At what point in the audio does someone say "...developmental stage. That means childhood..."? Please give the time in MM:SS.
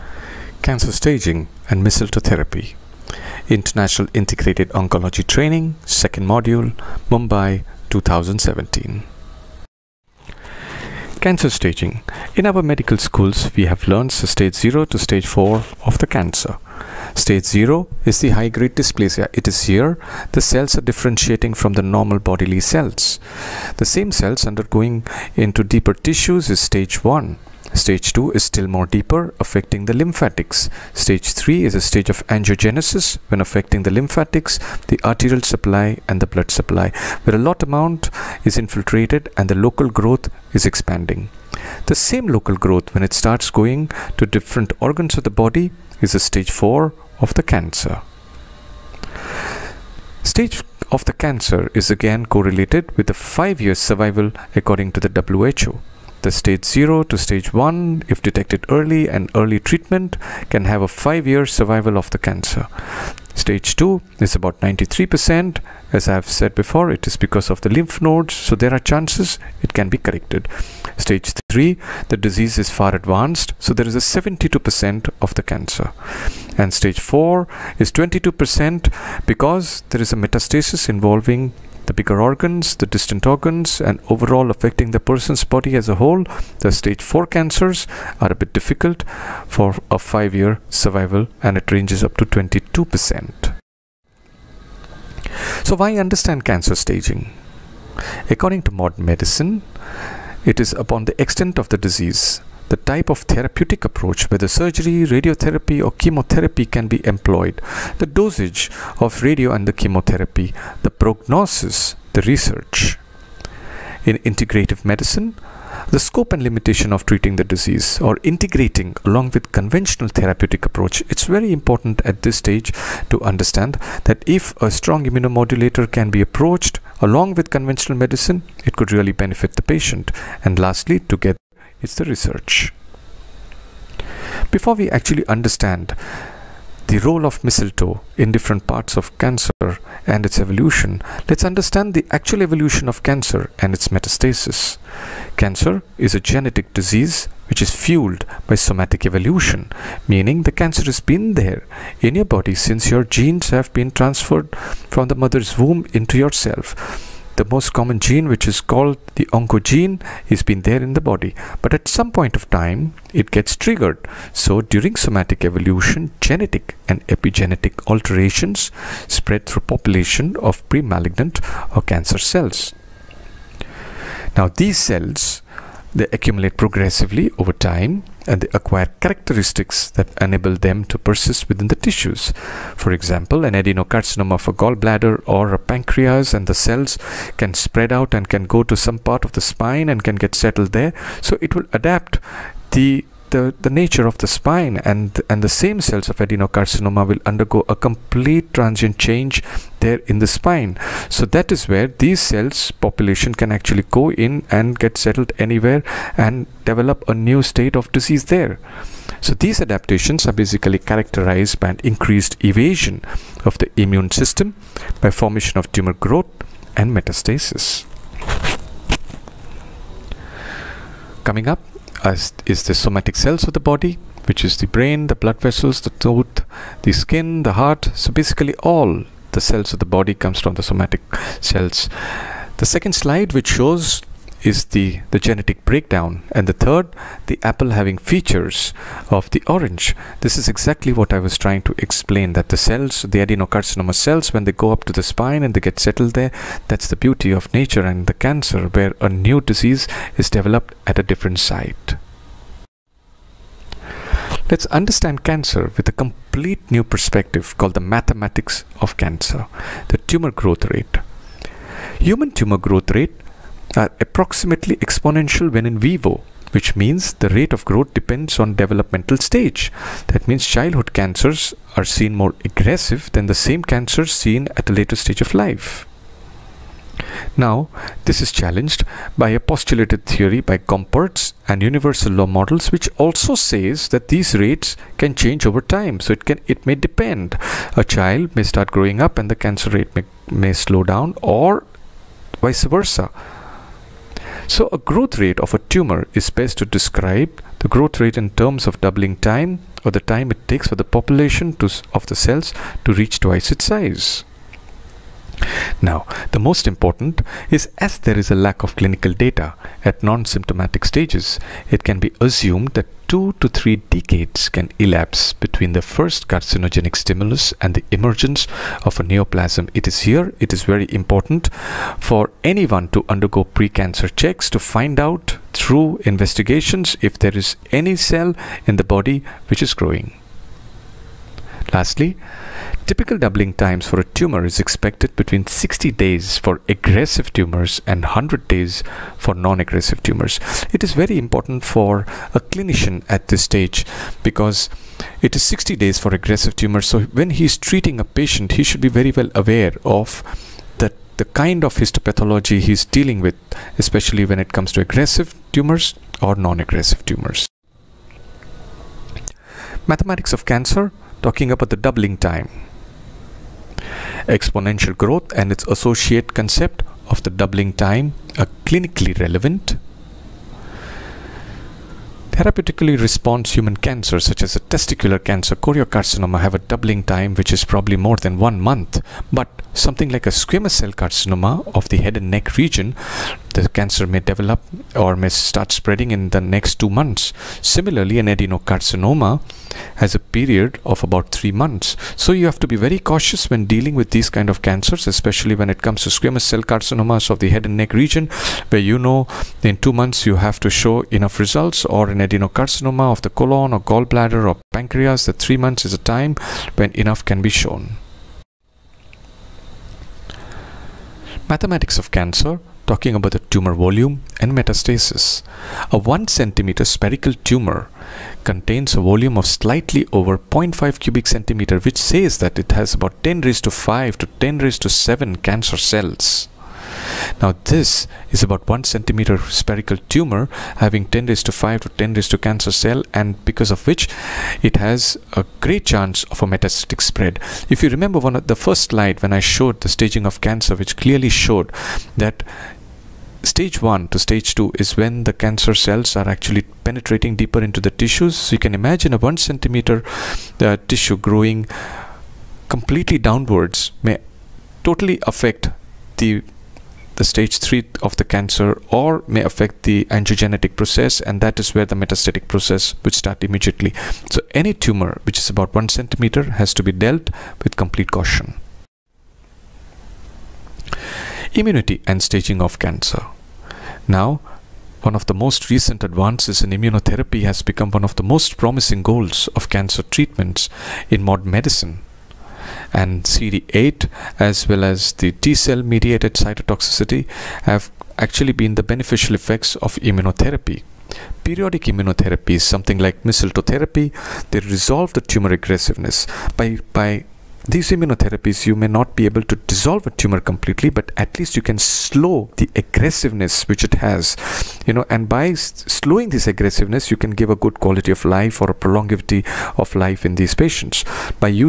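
04:28.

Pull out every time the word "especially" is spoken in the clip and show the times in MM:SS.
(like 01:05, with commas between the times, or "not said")
05:53, 06:35.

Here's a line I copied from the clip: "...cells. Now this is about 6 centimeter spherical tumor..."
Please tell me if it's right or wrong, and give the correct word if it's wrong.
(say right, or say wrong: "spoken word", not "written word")
wrong: "1", not "6".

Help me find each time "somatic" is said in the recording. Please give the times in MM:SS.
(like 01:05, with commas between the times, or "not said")
02:28, 02:44, 03:42, 03:50.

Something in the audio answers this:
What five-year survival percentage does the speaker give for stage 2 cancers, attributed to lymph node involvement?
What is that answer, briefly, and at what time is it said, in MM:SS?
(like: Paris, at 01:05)
93%, at 01:04.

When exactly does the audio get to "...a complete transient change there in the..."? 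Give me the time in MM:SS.
03:17.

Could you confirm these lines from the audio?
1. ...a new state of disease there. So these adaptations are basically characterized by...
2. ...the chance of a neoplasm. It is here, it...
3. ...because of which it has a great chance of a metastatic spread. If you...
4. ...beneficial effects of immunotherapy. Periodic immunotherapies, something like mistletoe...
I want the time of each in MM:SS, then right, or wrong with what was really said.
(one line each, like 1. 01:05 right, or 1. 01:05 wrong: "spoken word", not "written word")
1. 03:27 right
2. 05:17 wrong: "emergence", not "chance"
3. 07:13 right
4. 08:08 right.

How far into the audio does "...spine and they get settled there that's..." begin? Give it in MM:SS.
04:05.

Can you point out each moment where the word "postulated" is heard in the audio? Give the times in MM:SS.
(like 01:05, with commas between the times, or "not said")
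04:39.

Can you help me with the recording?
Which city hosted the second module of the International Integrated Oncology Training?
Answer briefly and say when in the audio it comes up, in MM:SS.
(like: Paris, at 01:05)
Mumbai, at 00:07.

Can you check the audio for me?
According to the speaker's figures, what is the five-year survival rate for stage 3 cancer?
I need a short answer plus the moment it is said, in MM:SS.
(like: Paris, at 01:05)
72%, at 01:14.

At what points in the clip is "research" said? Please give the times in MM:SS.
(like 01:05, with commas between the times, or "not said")
01:52, 02:12.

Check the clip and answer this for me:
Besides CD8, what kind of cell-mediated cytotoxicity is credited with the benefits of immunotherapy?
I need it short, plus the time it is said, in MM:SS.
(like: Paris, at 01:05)
T cell, at 08:05.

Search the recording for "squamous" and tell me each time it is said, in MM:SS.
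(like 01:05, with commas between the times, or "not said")
06:20, 06:36.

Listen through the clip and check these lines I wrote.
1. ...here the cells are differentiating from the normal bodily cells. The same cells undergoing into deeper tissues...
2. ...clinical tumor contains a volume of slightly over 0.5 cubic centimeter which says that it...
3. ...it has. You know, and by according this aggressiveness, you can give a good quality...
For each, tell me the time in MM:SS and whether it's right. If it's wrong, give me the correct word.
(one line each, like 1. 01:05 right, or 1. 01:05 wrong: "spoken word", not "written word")
1. 00:19 right
2. 06:56 wrong: "spherical", not "clinical"
3. 08:23 wrong: "slowing", not "according".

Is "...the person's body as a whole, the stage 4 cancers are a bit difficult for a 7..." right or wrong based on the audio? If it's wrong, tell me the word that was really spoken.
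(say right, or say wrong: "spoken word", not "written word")
wrong: "5", not "7".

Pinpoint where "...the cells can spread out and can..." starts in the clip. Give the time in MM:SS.
03:06.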